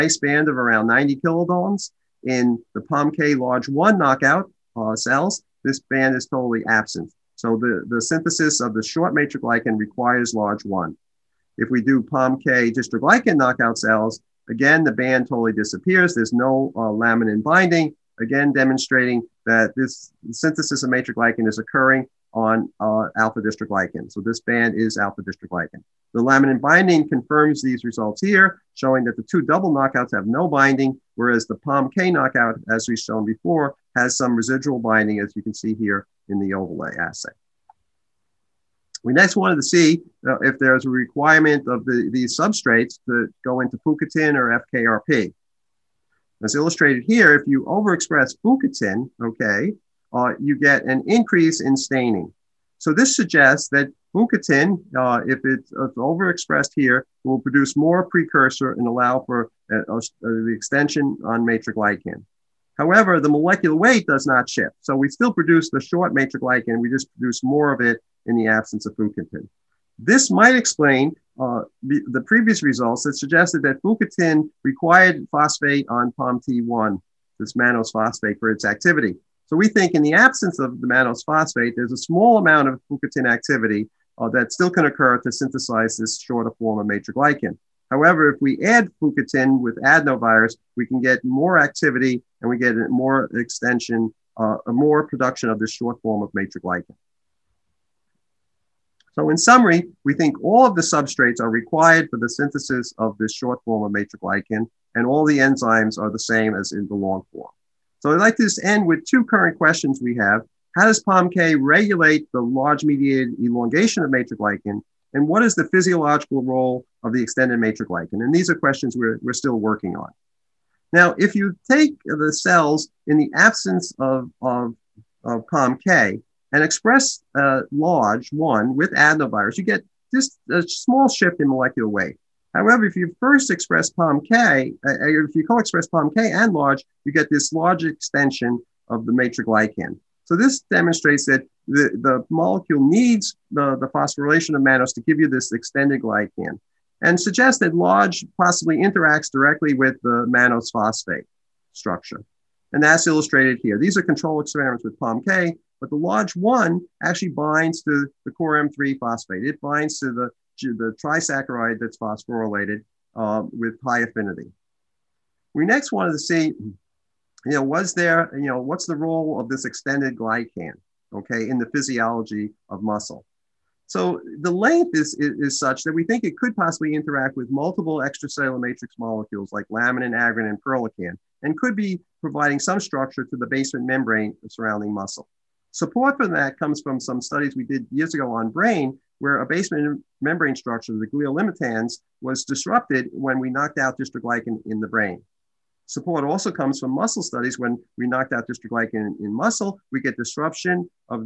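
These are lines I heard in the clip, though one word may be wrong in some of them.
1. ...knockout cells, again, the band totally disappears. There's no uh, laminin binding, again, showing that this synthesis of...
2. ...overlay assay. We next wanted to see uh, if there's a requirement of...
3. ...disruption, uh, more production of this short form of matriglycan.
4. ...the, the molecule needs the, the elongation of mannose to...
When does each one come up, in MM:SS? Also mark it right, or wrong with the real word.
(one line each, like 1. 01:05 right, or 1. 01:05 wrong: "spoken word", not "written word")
1. 00:13 wrong: "demonstrating", not "showing"
2. 00:36 right
3. 01:33 wrong: "extension", not "disruption"
4. 02:21 wrong: "phosphorylation", not "elongation".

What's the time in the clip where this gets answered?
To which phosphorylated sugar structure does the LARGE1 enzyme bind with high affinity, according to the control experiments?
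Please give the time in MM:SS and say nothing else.
02:38.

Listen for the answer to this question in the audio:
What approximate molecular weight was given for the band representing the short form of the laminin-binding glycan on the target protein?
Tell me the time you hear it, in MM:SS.
00:00.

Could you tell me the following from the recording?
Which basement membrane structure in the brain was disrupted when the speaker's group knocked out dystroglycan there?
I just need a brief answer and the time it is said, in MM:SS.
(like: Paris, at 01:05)
glial limitans, at 03:11.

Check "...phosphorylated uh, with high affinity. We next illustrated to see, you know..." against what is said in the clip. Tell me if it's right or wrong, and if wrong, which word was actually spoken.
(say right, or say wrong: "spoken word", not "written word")
wrong: "wanted", not "illustrated".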